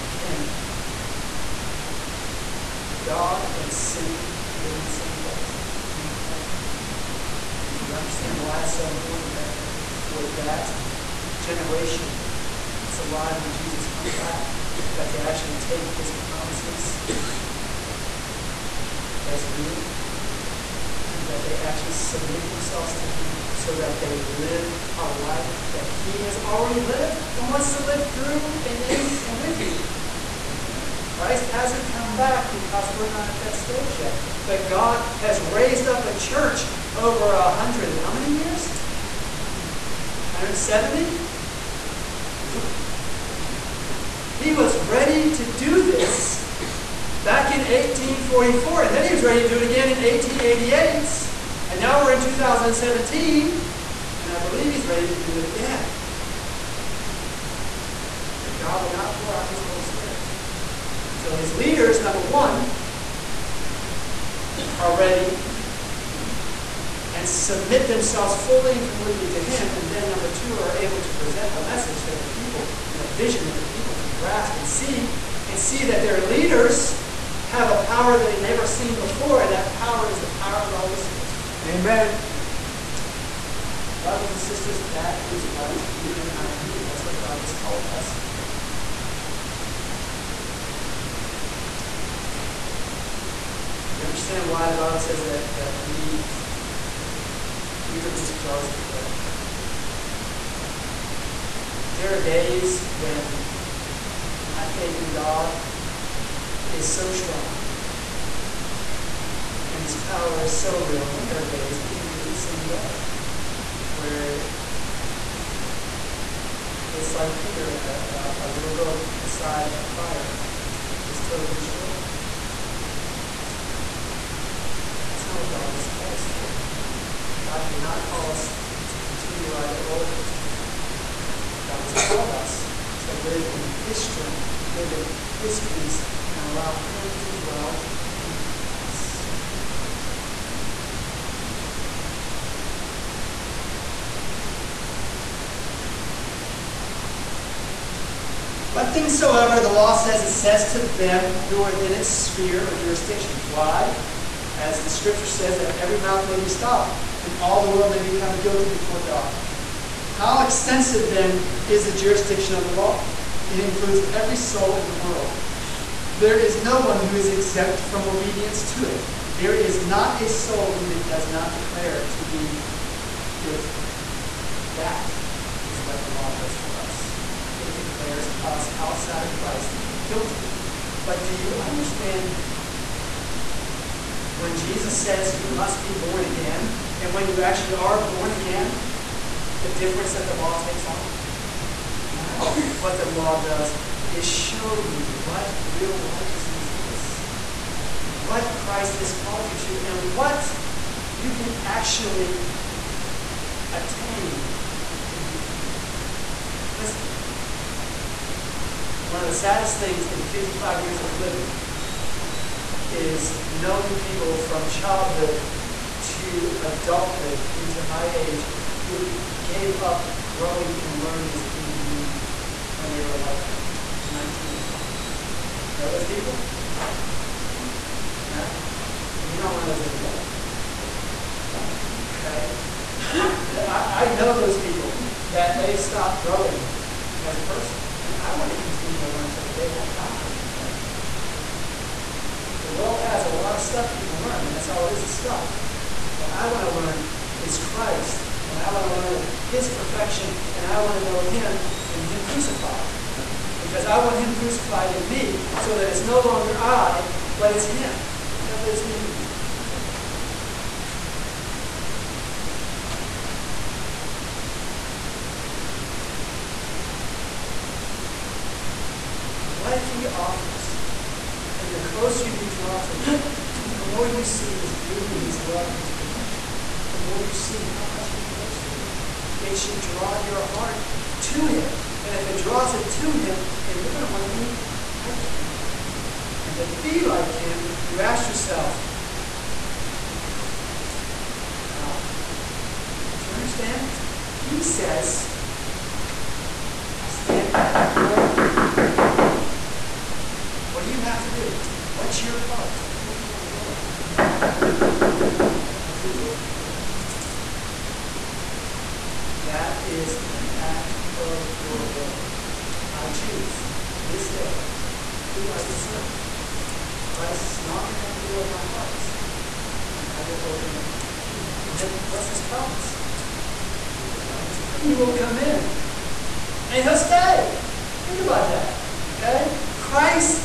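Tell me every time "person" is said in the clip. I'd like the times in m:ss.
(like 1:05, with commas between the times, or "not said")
3:57.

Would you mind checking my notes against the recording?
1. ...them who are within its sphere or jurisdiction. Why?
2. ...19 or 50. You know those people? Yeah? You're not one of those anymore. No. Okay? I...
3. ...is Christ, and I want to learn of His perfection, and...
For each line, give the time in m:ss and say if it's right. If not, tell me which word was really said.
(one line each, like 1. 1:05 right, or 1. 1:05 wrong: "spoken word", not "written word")
1. 2:30 right
2. 3:44 wrong: "20", not "50"
3. 4:07 right.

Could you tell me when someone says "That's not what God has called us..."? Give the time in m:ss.
2:05.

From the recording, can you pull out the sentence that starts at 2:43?
It includes every soul in the world.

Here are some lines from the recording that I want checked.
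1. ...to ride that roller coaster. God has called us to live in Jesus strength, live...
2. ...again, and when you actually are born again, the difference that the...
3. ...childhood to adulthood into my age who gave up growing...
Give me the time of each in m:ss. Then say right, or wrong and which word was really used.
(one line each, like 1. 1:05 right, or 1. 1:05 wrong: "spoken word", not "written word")
1. 2:09 wrong: "His", not "Jesus"
2. 3:06 right
3. 3:34 right.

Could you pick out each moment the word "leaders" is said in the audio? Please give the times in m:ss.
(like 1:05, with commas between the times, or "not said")
1:01, 1:16.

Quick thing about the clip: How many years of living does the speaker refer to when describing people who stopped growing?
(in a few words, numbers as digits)
55.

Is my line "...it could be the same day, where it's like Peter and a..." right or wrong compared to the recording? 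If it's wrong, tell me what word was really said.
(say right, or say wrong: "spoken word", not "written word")
right.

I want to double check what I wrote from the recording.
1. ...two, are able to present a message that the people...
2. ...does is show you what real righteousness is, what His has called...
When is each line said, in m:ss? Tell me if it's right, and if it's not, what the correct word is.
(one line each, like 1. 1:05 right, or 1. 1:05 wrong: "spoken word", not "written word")
1. 1:10 right
2. 3:13 wrong: "Christ", not "His".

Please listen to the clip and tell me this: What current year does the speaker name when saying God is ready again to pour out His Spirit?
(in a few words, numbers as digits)
2017.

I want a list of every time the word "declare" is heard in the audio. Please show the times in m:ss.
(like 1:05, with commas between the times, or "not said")
2:51, 2:57.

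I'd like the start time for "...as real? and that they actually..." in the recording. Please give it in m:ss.
0:19.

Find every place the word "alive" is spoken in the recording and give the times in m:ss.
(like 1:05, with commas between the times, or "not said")
0:12.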